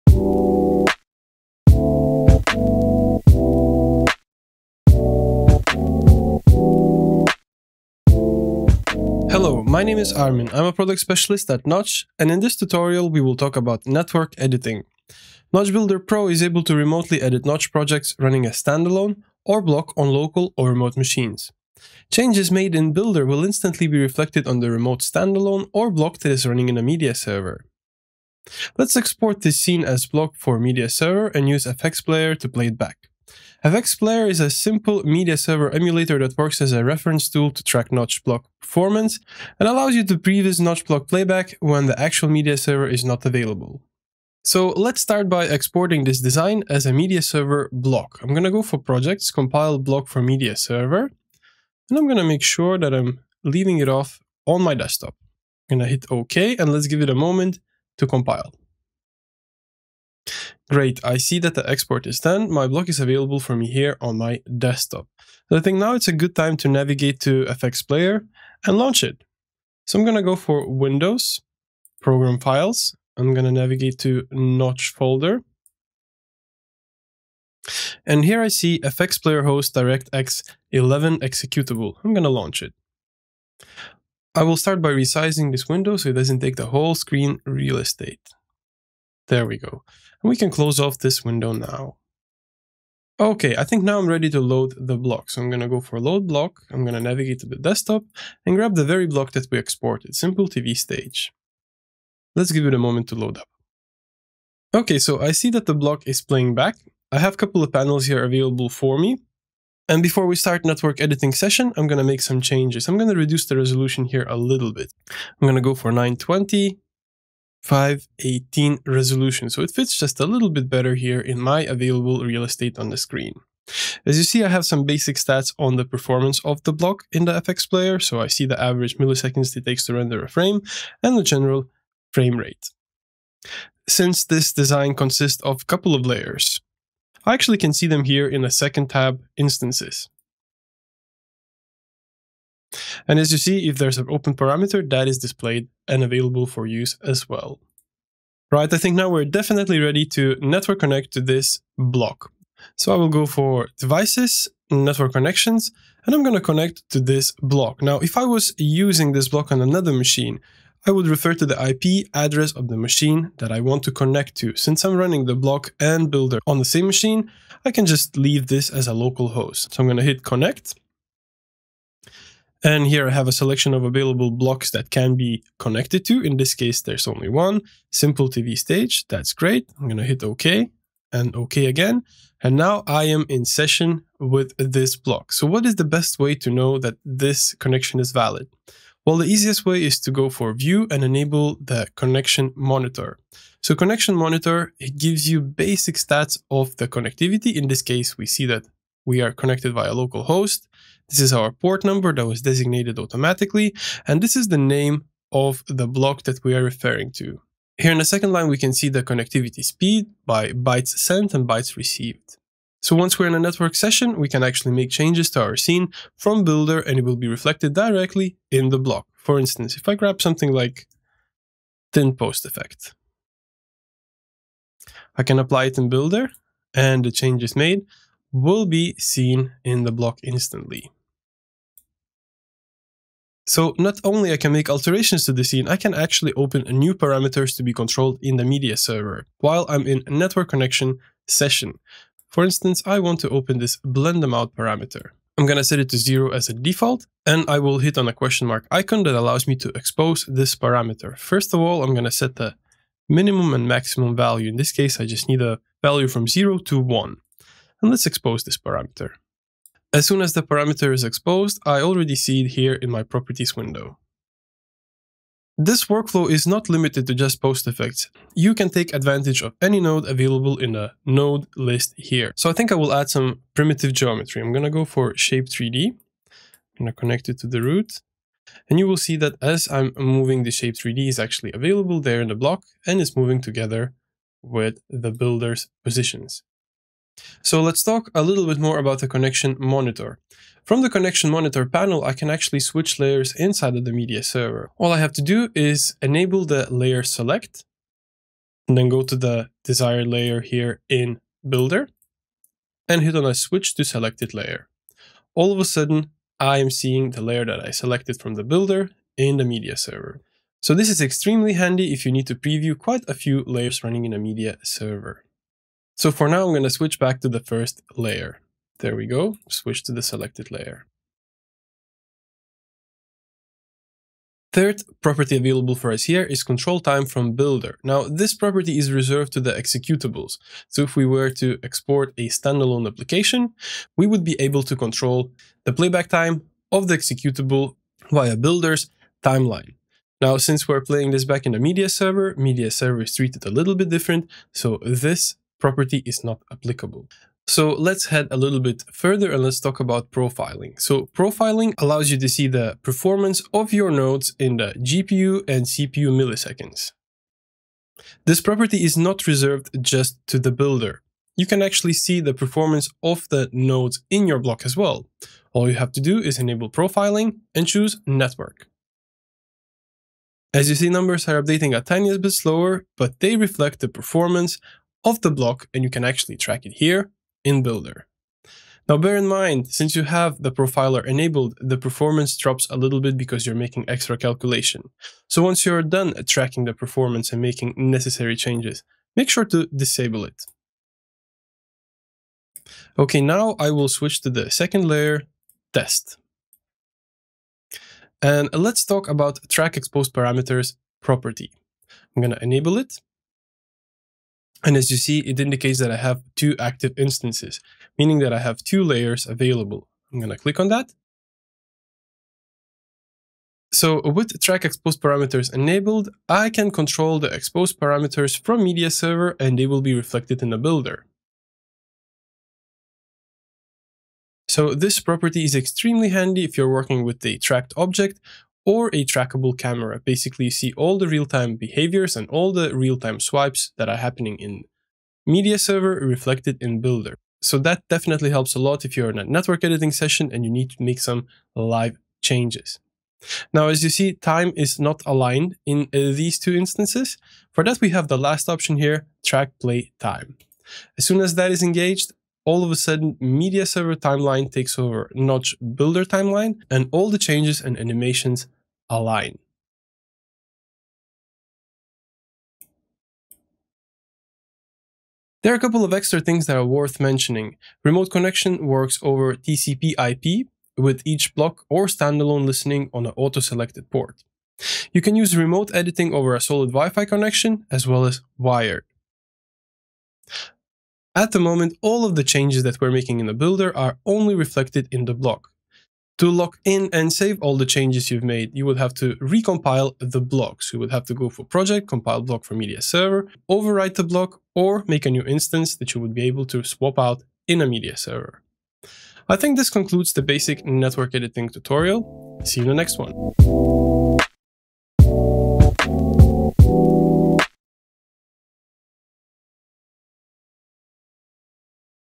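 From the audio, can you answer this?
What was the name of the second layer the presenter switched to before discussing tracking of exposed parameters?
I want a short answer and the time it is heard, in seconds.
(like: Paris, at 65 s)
test, at 395 s.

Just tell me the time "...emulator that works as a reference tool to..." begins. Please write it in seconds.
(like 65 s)
35 s.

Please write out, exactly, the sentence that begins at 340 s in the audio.
Now, since we're playing this back in the media server, media server is treated a little bit different.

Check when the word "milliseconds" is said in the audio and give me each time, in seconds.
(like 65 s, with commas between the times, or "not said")
128 s, 356 s.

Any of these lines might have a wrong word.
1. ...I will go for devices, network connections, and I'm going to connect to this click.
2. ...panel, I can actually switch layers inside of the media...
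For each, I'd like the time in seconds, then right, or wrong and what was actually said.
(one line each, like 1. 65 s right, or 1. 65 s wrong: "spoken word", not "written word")
1. 152 s wrong: "block", not "click"
2. 291 s right.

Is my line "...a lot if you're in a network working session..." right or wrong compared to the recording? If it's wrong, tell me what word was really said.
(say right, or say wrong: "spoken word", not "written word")
wrong: "editing", not "working".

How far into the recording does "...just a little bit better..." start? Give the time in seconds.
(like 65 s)
119 s.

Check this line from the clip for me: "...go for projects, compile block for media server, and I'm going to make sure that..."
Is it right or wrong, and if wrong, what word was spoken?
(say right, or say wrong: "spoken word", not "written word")
right.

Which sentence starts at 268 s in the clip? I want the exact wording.
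You can take advantage of any node available in the node list here.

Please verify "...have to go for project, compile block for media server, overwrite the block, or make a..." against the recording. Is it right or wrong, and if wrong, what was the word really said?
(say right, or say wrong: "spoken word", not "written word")
right.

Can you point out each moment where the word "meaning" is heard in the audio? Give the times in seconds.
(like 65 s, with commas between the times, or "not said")
407 s.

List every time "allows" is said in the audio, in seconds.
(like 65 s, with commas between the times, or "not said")
39 s, 249 s, 351 s.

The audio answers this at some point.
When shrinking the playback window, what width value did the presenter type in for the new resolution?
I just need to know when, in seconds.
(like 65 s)
115 s.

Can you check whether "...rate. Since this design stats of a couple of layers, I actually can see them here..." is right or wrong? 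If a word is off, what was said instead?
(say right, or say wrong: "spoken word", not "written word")
wrong: "consists", not "stats".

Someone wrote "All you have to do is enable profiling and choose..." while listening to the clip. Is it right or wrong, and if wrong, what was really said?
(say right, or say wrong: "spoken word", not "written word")
right.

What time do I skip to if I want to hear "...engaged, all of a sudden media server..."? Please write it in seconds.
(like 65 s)
451 s.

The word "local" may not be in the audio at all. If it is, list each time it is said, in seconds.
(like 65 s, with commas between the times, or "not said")
20 s, 168 s, 199 s.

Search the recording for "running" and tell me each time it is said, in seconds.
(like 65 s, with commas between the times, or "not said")
18 s, 26 s, 164 s, 313 s.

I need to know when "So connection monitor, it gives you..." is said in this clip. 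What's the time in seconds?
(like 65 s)
193 s.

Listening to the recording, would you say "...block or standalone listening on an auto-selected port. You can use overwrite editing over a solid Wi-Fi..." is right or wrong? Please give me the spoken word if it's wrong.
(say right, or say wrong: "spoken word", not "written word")
wrong: "remote", not "overwrite".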